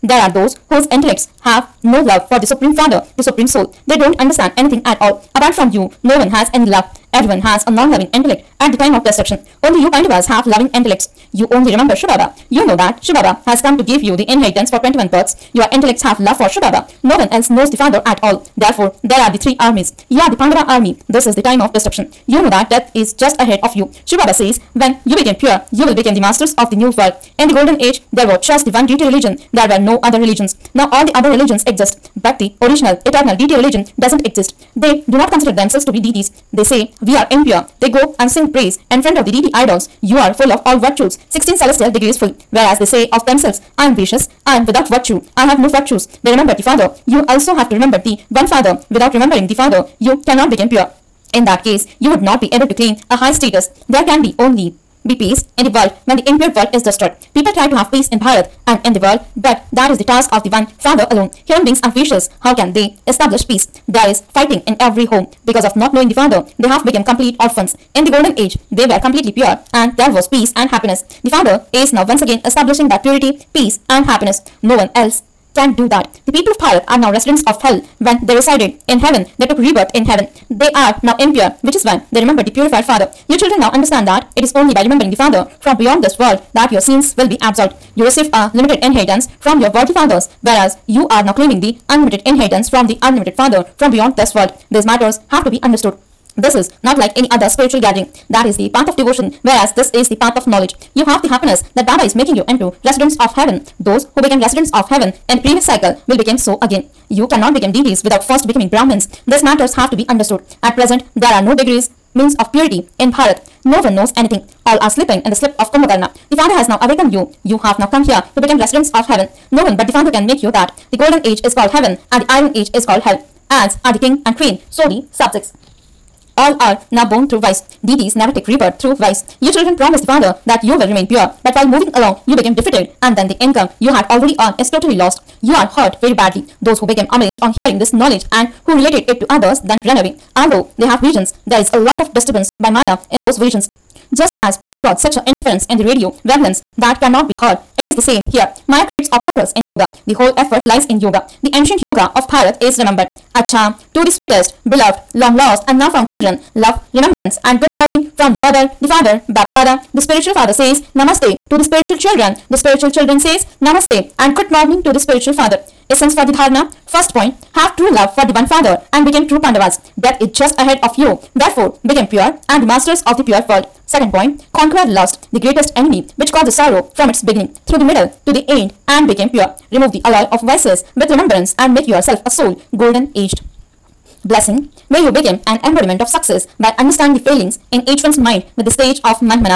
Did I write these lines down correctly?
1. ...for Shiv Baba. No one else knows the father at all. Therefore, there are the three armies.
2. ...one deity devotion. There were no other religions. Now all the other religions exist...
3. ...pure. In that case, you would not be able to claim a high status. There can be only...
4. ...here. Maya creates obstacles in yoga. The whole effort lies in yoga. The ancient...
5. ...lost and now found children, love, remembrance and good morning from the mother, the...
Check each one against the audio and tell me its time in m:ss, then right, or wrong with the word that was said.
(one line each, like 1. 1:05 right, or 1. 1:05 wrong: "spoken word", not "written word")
1. 0:16 right
2. 0:28 wrong: "religion", not "devotion"
3. 0:50 right
4. 2:28 right
5. 2:35 right.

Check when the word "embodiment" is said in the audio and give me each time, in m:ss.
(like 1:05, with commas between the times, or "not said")
3:05.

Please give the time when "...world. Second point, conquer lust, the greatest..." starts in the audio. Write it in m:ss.
2:53.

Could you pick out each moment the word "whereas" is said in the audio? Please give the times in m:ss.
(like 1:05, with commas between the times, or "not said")
0:42, 1:30, 1:39.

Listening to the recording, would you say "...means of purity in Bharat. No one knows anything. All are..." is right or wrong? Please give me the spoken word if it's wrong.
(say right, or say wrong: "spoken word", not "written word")
right.